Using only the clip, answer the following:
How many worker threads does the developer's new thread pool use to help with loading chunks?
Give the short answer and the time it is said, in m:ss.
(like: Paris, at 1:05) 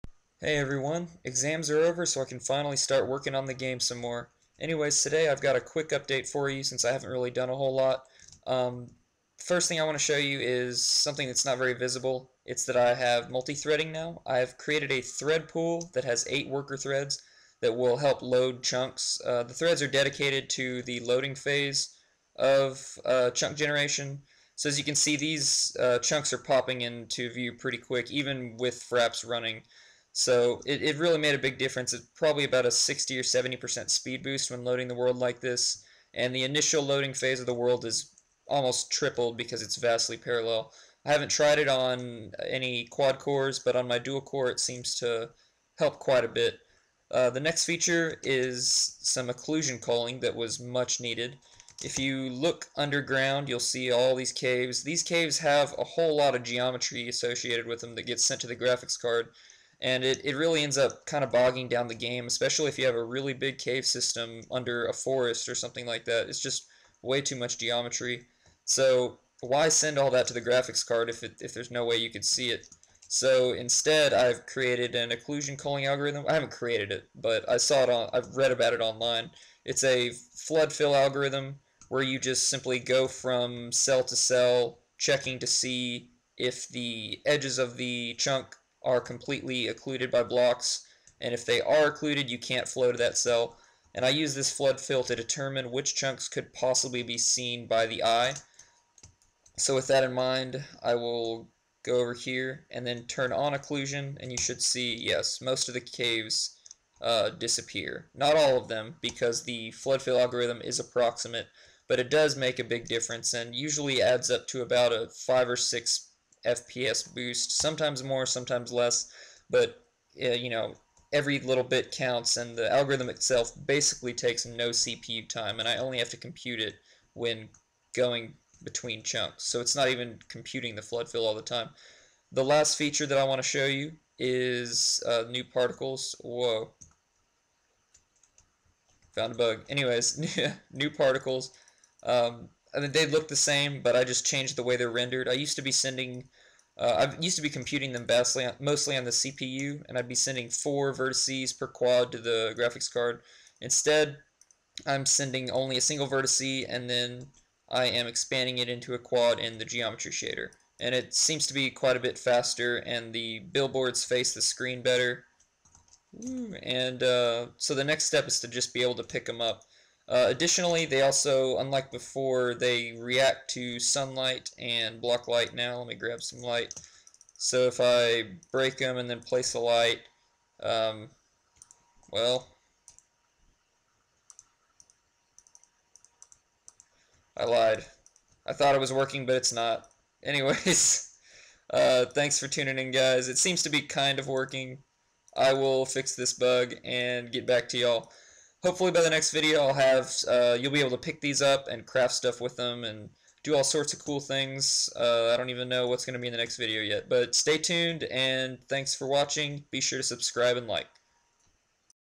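8, at 0:16.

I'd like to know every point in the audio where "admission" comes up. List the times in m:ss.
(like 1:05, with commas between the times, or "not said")
not said.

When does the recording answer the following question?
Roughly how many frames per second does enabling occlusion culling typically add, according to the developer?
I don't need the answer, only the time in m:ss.
1:55.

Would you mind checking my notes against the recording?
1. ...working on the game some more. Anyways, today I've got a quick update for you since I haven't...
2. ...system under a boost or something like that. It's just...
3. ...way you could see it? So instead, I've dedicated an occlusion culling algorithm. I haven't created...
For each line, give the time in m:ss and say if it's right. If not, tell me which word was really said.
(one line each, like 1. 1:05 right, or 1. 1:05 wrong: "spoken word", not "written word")
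1. 0:03 right
2. 1:03 wrong: "forest", not "boost"
3. 1:11 wrong: "created", not "dedicated".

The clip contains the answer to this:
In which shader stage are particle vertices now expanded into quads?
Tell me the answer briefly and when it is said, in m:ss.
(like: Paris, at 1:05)
geometry shader, at 2:39.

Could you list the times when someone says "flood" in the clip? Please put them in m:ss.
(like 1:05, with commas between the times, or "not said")
1:20, 1:34, 1:49, 2:10.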